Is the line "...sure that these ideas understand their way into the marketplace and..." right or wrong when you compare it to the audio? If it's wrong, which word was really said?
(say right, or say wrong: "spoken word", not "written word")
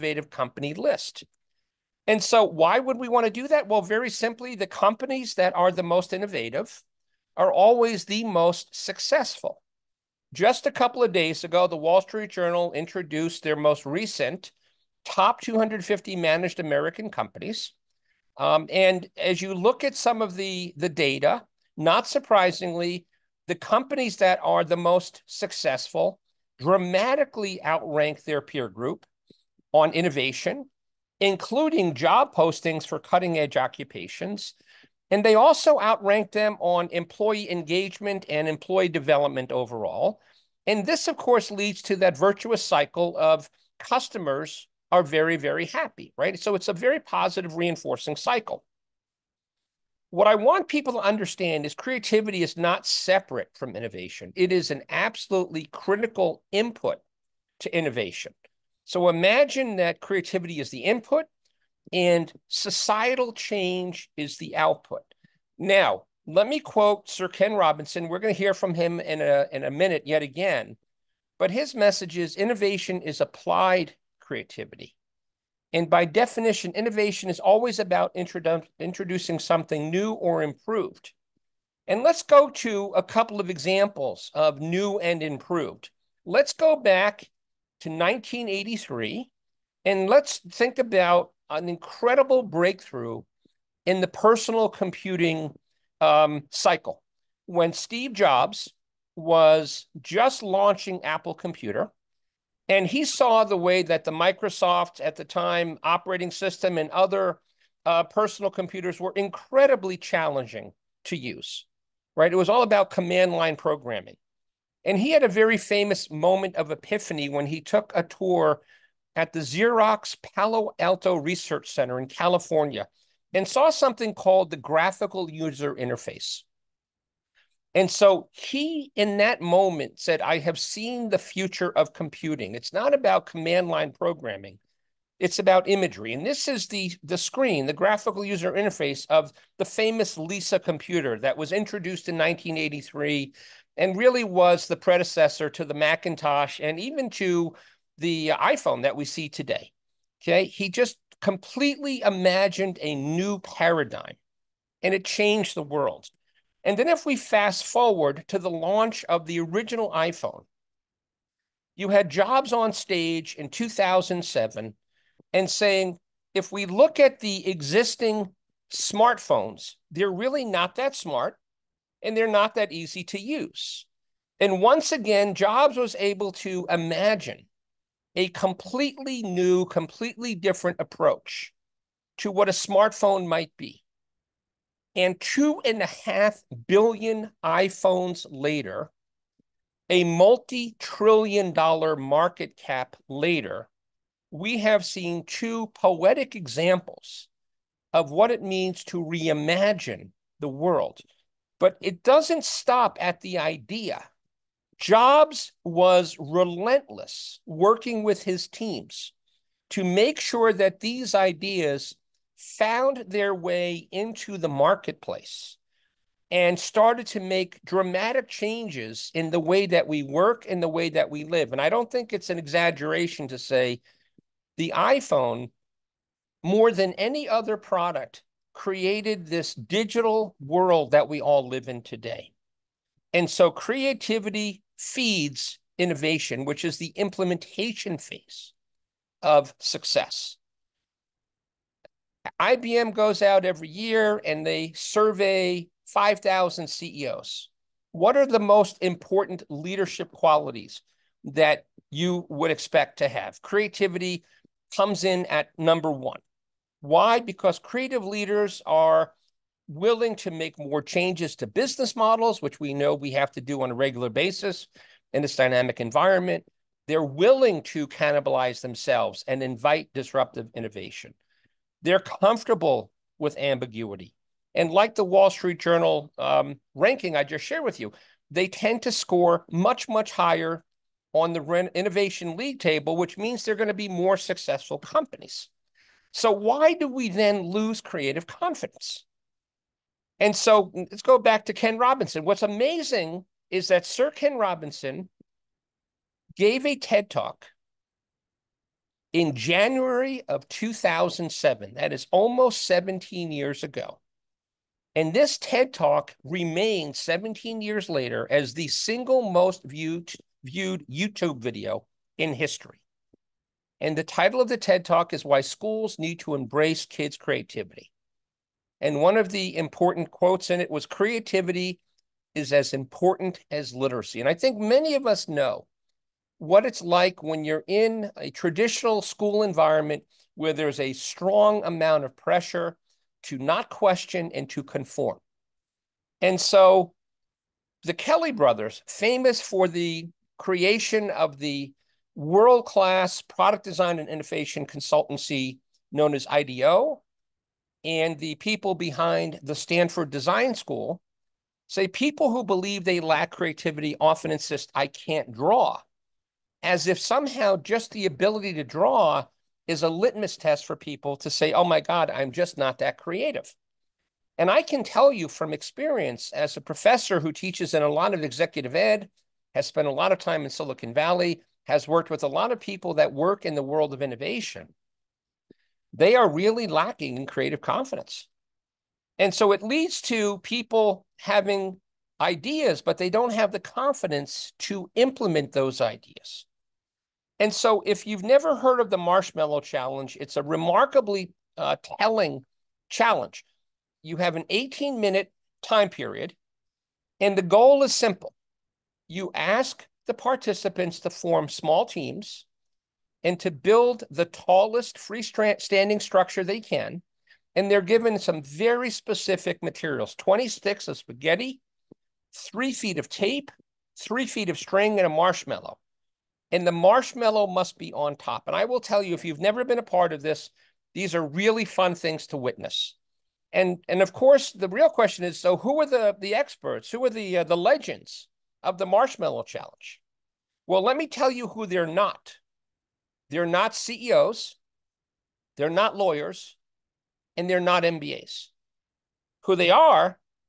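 wrong: "found", not "understand".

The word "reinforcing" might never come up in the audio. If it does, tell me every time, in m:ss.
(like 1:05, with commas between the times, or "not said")
0:47.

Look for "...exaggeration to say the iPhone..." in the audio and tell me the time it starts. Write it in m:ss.
3:42.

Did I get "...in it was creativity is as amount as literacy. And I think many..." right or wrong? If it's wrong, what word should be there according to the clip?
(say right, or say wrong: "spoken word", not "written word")
wrong: "important", not "amount".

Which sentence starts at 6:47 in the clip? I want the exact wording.
And they're given some very specific materials 20 sticks of spaghetti, three feet of tape, three feet of string, and a marshmallow.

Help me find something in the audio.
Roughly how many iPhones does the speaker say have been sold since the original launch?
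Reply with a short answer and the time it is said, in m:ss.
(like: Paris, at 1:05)
2.5 billion, at 3:05.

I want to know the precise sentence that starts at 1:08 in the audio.
We're going to hear from him in a, in a minute yet again.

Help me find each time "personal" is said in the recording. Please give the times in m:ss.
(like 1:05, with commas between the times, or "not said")
1:34, 1:48.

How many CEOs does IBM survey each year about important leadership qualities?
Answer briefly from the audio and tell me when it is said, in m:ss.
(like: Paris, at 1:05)
5,000, at 4:05.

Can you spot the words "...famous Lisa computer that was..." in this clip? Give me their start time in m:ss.
2:19.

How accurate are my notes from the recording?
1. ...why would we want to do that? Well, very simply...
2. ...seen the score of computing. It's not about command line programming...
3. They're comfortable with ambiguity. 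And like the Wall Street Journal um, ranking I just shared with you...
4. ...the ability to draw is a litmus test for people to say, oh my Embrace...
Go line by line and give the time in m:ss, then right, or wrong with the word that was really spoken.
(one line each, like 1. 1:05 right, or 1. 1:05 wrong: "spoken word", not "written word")
1. 0:02 right
2. 2:10 wrong: "future", not "score"
3. 4:31 right
4. 5:57 wrong: "God", not "Embrace".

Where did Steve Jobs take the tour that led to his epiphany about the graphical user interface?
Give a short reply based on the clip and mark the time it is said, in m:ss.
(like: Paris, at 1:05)
Xerox Palo Alto Research Center, at 1:59.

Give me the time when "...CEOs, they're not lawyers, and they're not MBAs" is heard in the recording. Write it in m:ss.
7:13.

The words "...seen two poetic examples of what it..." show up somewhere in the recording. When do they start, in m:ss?
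3:14.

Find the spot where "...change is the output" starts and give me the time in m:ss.
1:03.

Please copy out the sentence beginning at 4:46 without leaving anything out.
So, why do we then lose creative confidence?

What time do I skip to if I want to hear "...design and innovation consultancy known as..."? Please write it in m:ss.
5:43.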